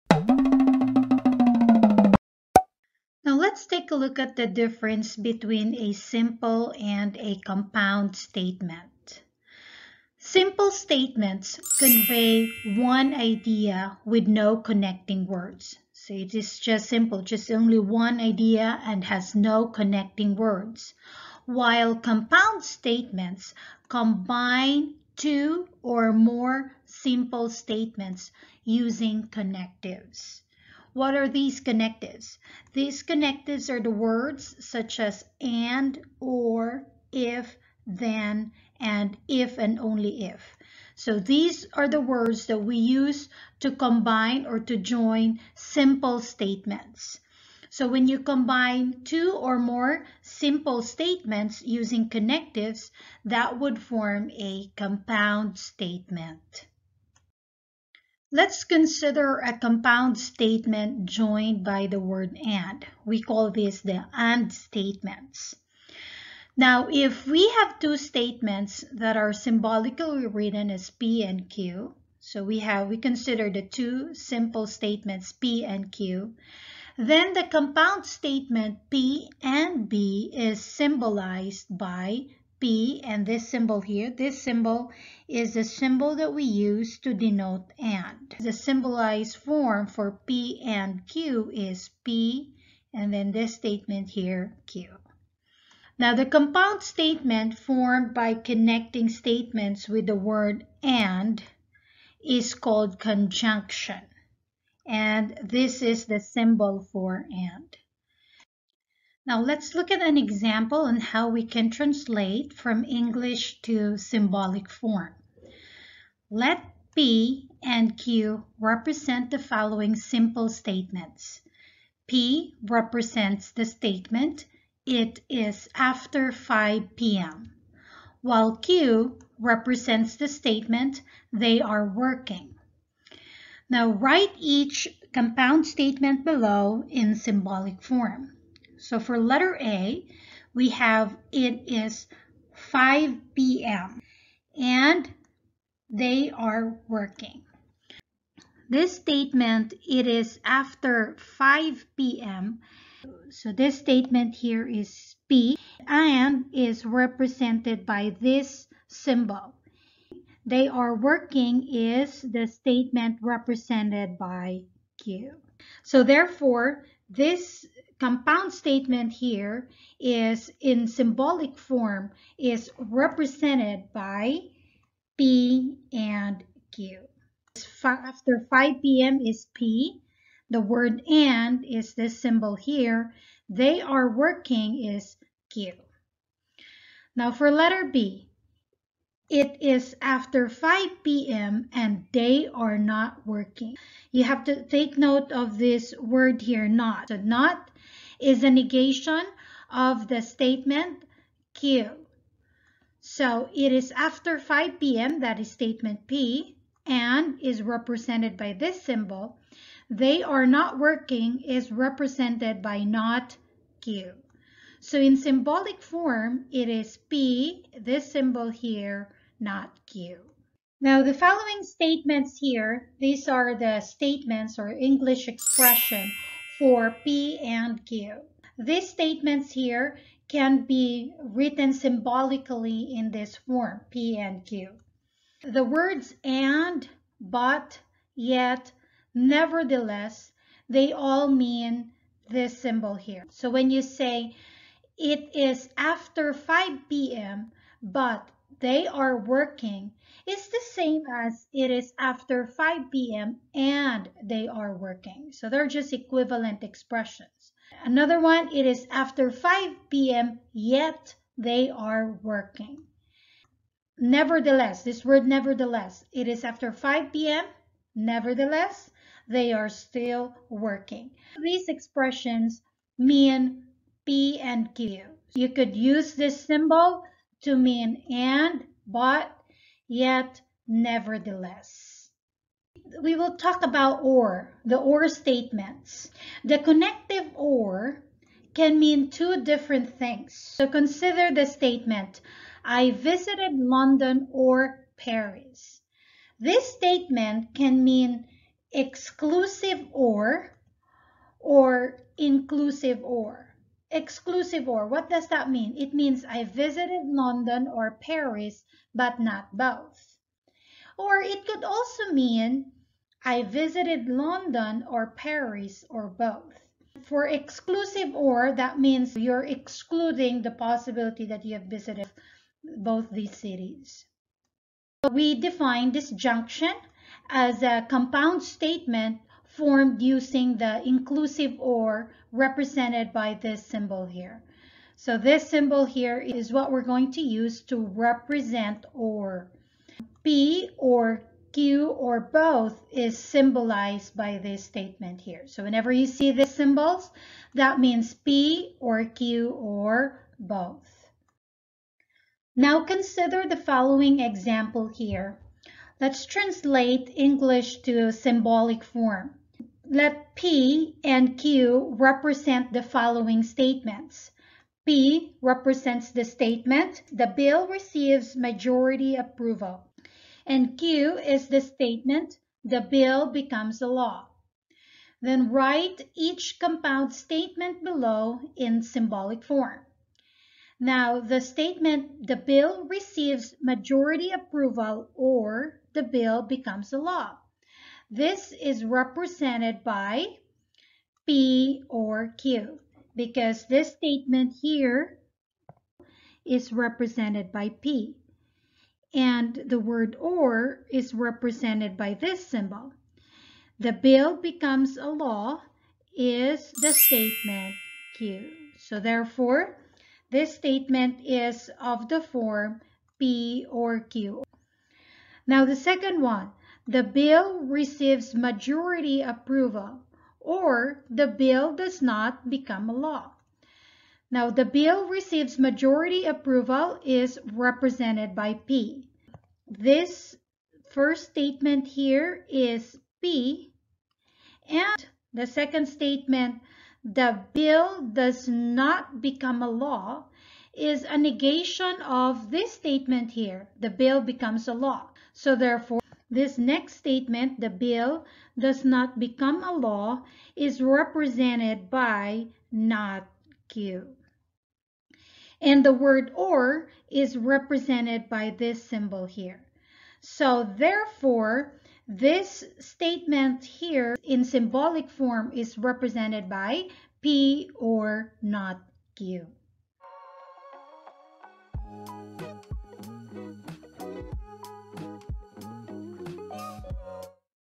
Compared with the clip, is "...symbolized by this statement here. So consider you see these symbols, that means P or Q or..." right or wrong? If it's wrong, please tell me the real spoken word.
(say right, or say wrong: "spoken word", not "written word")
wrong: "whenever", not "consider".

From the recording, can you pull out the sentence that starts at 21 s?
While compound statements combine two or more simple statements using connectives.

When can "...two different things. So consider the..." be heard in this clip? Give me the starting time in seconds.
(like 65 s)
289 s.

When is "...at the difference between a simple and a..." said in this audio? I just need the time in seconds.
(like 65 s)
4 s.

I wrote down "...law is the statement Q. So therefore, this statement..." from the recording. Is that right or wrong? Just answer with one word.
right.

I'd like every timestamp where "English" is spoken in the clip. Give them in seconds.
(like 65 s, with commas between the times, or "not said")
112 s, 224 s, 357 s.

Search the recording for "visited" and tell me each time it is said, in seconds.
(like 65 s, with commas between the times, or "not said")
292 s, 306 s, 313 s, 321 s.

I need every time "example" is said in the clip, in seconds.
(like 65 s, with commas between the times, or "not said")
110 s, 354 s.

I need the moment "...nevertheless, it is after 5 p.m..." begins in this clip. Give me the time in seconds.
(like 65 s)
265 s.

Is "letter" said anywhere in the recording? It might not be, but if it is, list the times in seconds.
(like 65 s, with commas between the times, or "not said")
139 s, 187 s.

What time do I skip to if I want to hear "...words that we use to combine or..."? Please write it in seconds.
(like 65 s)
42 s.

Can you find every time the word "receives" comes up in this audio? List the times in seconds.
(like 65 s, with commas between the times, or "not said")
367 s, 382 s, 417 s, 425 s.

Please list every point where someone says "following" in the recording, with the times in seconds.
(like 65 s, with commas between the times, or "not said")
119 s, 221 s, 353 s, 362 s.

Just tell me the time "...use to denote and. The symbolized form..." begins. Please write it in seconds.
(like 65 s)
86 s.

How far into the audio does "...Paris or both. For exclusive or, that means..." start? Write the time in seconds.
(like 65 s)
315 s.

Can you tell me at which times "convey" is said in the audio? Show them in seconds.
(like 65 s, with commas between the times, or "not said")
11 s.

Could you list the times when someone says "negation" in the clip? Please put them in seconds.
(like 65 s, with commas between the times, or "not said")
198 s, 441 s.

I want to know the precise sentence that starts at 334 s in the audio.
So this symbol here is what we're going to use to represent or.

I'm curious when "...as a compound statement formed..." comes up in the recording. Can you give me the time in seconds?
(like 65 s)
327 s.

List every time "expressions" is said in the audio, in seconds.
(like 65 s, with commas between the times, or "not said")
225 s, 256 s, 271 s.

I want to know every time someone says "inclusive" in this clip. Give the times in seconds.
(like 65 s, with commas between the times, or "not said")
302 s, 330 s.